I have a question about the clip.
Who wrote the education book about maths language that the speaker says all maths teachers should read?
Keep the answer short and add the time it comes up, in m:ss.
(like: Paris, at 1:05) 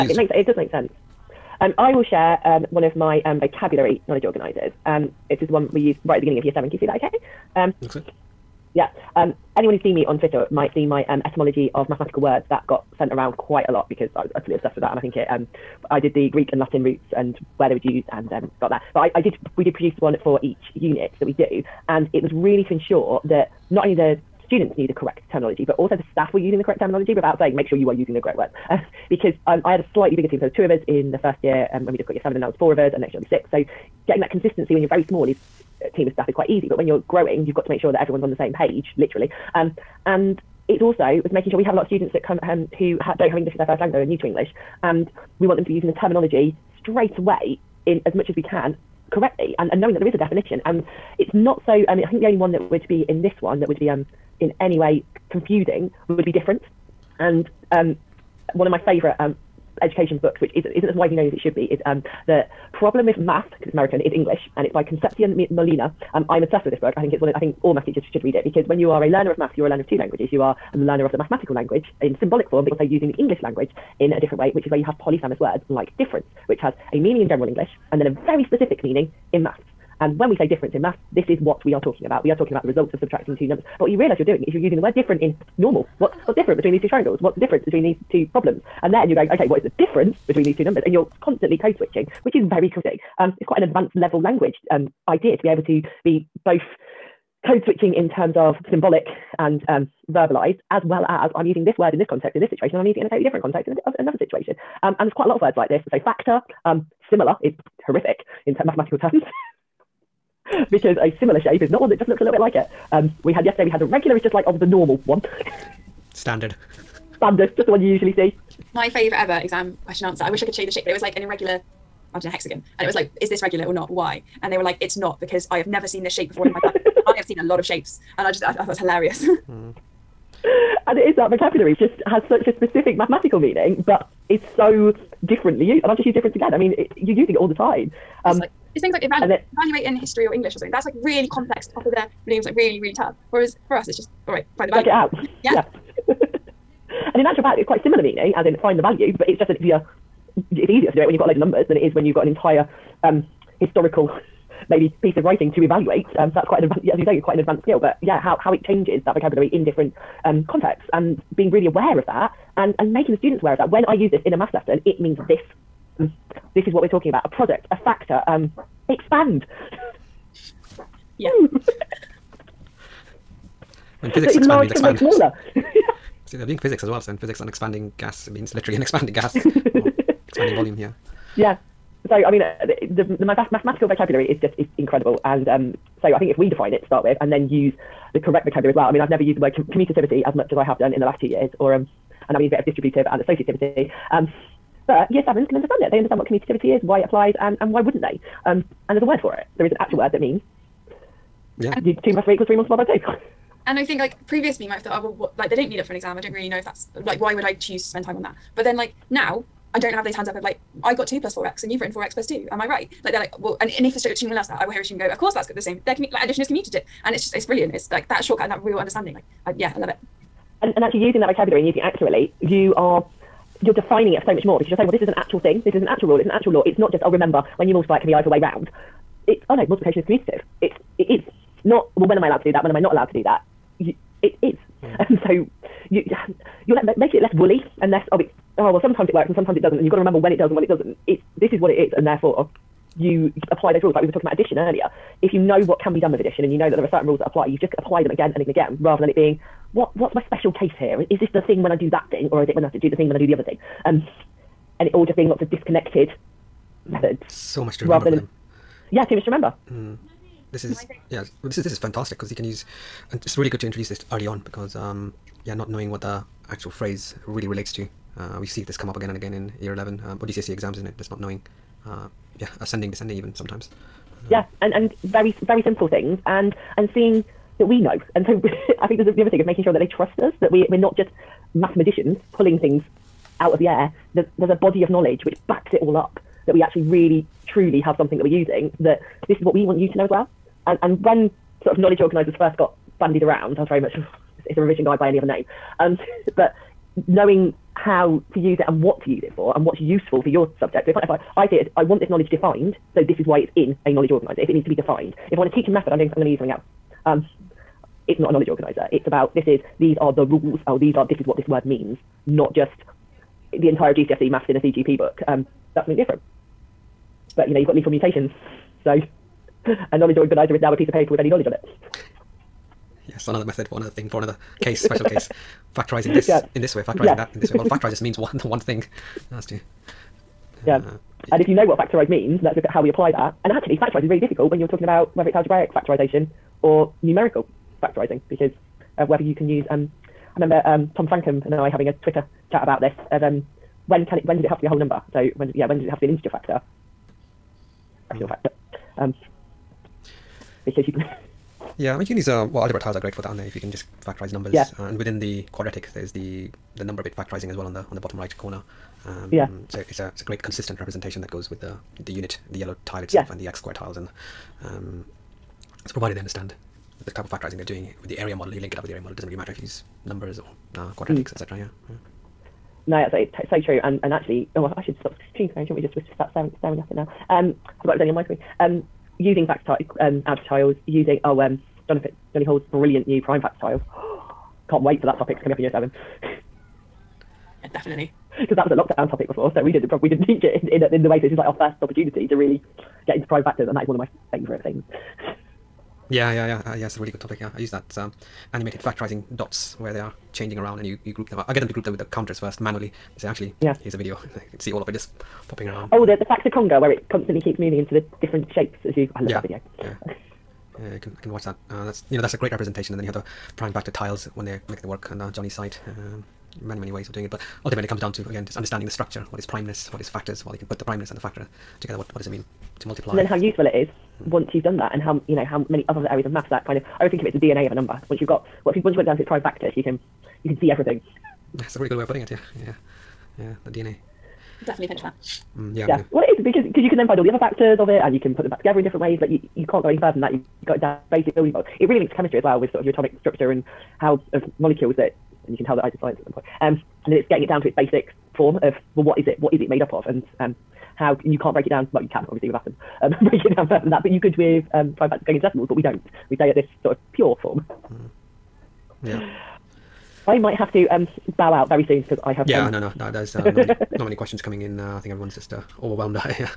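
Concepcion Molina, at 1:04.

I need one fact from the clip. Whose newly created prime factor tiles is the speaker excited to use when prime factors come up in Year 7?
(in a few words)
Johnny Hall.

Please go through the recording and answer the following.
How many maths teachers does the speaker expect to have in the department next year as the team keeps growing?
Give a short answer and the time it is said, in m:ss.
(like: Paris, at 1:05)
6, at 0:33.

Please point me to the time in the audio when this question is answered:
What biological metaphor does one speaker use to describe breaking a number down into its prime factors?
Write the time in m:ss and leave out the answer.
7:07.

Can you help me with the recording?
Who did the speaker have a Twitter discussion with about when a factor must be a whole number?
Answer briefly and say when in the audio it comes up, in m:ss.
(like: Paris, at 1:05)
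Tom Francome, at 5:40.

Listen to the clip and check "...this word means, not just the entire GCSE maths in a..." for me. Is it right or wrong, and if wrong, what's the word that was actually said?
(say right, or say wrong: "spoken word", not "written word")
right.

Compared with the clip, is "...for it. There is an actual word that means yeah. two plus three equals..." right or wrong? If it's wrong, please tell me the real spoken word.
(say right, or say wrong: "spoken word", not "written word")
right.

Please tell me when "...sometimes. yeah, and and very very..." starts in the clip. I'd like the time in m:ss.
4:33.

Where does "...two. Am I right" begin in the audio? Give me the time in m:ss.
3:32.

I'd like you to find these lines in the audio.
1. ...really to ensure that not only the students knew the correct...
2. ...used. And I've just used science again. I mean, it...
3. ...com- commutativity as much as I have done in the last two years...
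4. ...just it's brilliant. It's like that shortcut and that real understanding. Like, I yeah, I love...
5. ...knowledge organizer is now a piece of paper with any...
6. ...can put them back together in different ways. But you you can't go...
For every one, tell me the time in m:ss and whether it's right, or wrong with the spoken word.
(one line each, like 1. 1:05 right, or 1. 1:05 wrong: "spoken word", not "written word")
1. 0:22 right
2. 2:15 wrong: "difference", not "science"
3. 3:09 right
4. 3:37 right
5. 5:19 right
6. 7:18 right.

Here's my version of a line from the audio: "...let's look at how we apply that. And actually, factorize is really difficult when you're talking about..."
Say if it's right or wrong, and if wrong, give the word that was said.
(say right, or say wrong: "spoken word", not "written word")
right.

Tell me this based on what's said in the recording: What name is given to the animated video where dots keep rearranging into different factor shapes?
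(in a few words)
The factor conga.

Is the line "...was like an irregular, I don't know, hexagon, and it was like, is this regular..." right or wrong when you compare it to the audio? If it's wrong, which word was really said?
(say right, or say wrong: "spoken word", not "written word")
right.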